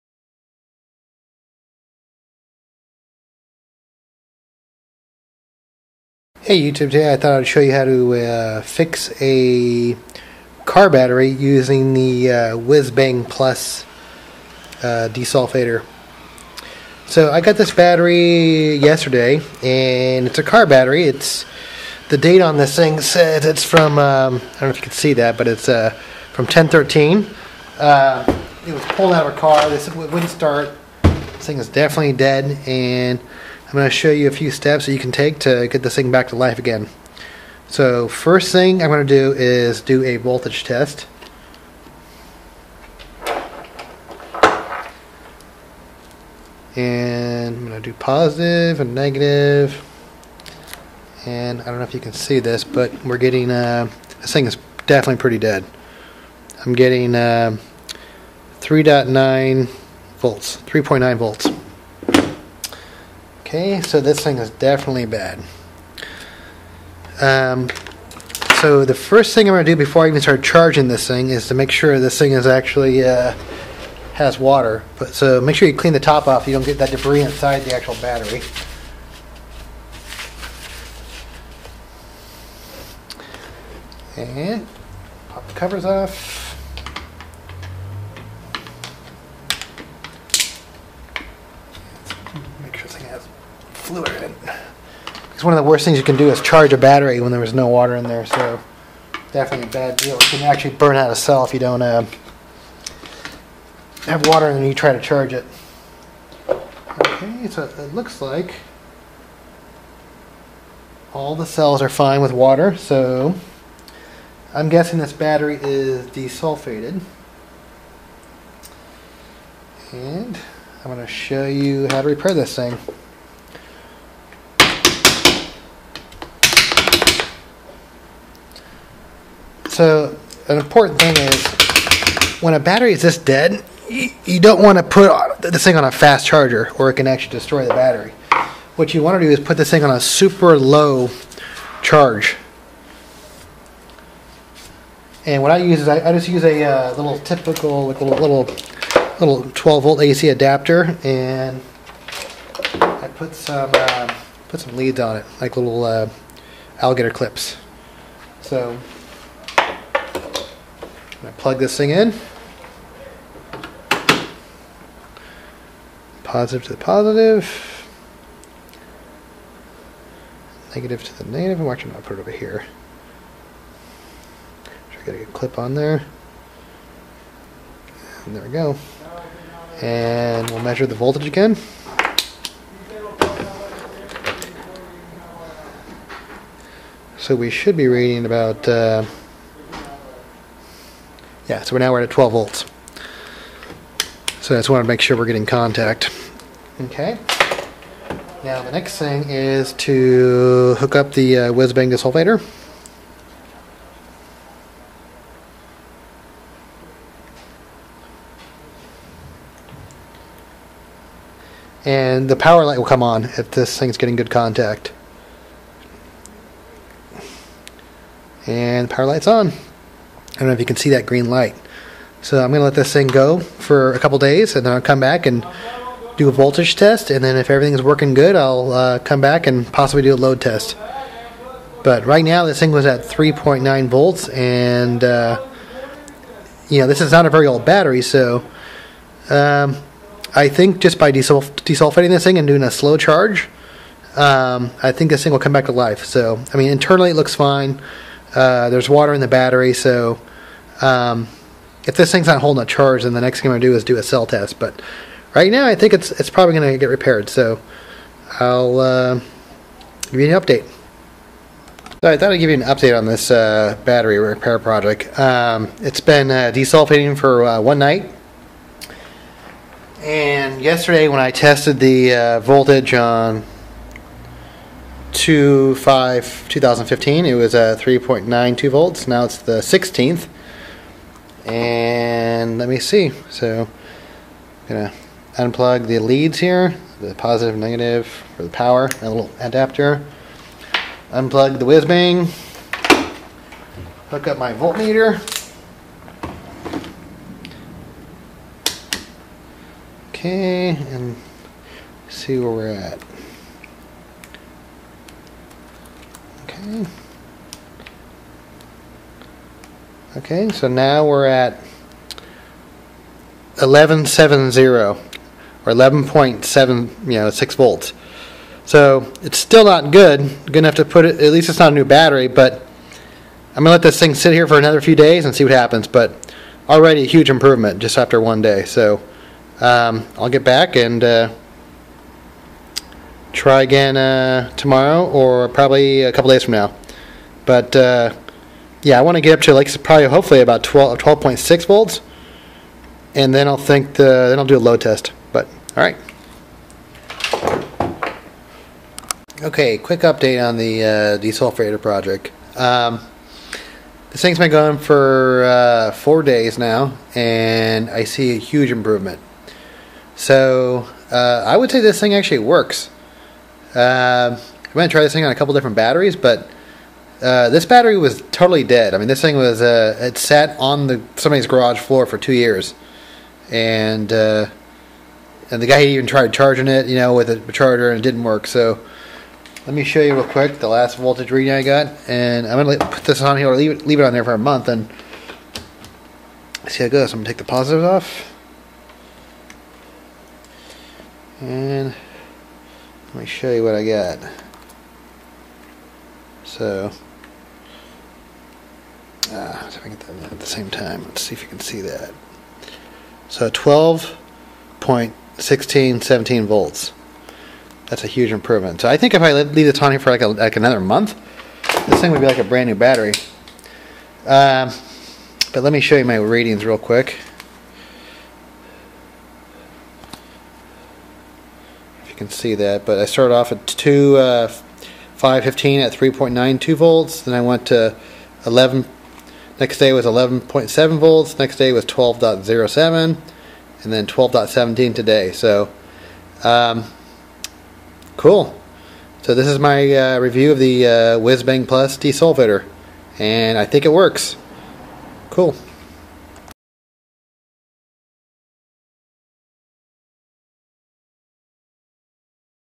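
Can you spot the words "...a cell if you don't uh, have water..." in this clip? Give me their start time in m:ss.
1:41.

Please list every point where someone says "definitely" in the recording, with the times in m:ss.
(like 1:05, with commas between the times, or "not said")
0:31, 0:54, 1:04, 1:39.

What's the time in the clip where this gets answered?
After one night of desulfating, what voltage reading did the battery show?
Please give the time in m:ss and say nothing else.
5:15.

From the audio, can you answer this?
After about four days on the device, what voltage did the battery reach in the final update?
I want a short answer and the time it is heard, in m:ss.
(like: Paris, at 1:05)
12.17 volts, at 7:14.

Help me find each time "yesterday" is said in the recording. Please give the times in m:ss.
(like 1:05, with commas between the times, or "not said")
0:18, 4:30.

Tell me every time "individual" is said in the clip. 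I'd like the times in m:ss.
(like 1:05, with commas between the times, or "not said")
not said.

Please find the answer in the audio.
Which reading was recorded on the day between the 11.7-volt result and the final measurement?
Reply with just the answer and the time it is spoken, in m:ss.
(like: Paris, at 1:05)
12.07 volts, at 7:11.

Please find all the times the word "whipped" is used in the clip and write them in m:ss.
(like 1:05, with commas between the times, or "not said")
not said.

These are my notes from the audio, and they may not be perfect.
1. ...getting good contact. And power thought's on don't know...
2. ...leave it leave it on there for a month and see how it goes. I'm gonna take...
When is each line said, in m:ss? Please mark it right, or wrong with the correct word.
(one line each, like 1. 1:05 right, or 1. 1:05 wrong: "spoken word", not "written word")
1. 3:33 wrong: "light", not "thought"
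2. 6:23 right.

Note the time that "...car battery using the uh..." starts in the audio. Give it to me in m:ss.
0:10.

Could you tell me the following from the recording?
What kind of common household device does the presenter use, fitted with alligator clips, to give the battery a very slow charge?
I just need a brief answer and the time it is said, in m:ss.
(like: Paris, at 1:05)
12 volt AC adapter, at 2:29.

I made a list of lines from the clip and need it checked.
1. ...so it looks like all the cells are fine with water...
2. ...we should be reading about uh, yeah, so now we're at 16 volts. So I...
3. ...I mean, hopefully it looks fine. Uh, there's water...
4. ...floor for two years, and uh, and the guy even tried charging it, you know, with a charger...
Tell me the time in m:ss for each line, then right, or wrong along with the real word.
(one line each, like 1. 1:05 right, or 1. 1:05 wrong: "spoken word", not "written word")
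1. 1:47 right
2. 3:07 wrong: "12", not "16"
3. 4:06 wrong: "internally", not "hopefully"
4. 6:11 right.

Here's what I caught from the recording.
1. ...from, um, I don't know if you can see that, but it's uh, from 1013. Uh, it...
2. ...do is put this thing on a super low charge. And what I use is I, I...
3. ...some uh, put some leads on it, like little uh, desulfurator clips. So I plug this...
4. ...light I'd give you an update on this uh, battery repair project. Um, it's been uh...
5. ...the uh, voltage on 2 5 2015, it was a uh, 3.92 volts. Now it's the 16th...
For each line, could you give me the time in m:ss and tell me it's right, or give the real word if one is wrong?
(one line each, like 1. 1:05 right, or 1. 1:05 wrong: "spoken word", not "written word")
1. 0:23 right
2. 2:19 right
3. 2:33 wrong: "alligator", not "desulfurator"
4. 4:22 wrong: "thought", not "light"
5. 4:31 right.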